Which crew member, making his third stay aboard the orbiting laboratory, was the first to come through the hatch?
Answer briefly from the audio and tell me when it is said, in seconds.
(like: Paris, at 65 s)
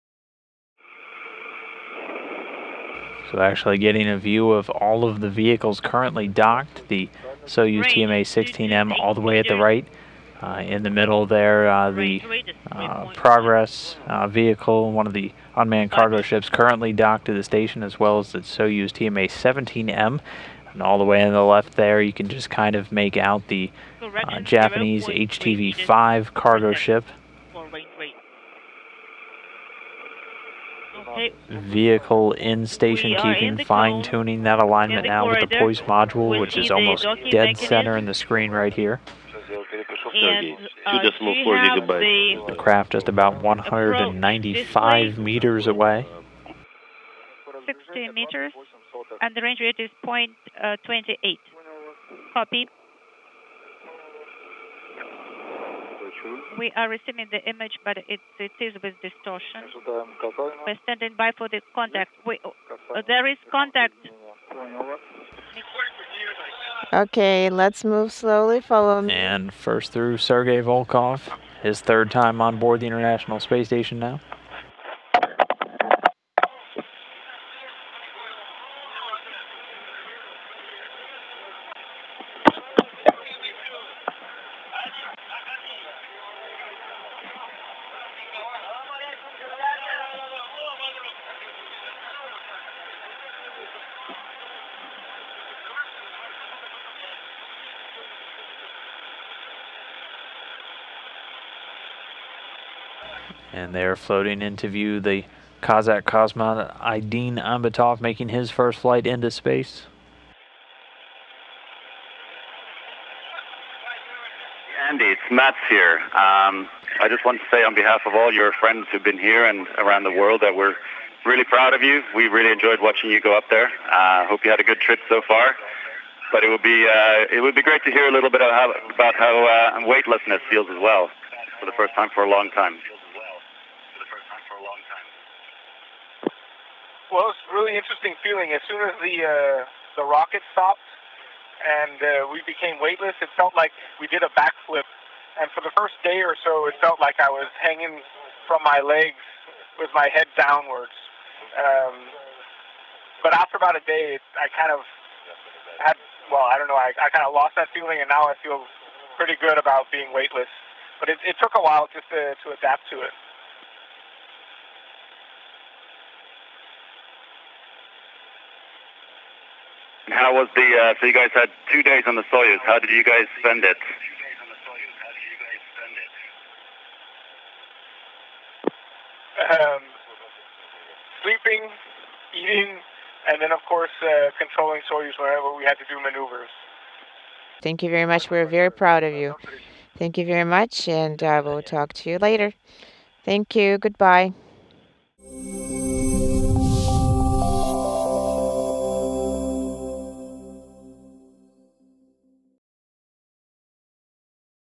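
Sergei Volkov, at 70 s.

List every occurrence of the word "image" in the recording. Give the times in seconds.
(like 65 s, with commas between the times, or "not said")
57 s.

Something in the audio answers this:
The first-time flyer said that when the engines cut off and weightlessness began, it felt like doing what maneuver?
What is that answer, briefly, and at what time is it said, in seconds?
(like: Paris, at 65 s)
a backflip, at 144 s.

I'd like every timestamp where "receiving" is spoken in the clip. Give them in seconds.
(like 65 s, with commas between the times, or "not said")
56 s.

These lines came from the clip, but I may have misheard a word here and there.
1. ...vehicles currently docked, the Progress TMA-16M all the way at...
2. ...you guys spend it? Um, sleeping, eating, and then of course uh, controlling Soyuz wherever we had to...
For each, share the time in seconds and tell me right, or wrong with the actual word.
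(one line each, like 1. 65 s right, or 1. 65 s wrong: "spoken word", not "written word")
1. 5 s wrong: "Soyuz", not "Progress"
2. 172 s right.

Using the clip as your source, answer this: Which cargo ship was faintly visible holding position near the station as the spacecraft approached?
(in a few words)
Japanese HTV-5.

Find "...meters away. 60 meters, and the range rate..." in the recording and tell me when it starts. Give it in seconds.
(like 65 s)
45 s.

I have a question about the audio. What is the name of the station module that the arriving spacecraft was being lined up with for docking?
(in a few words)
Poisk.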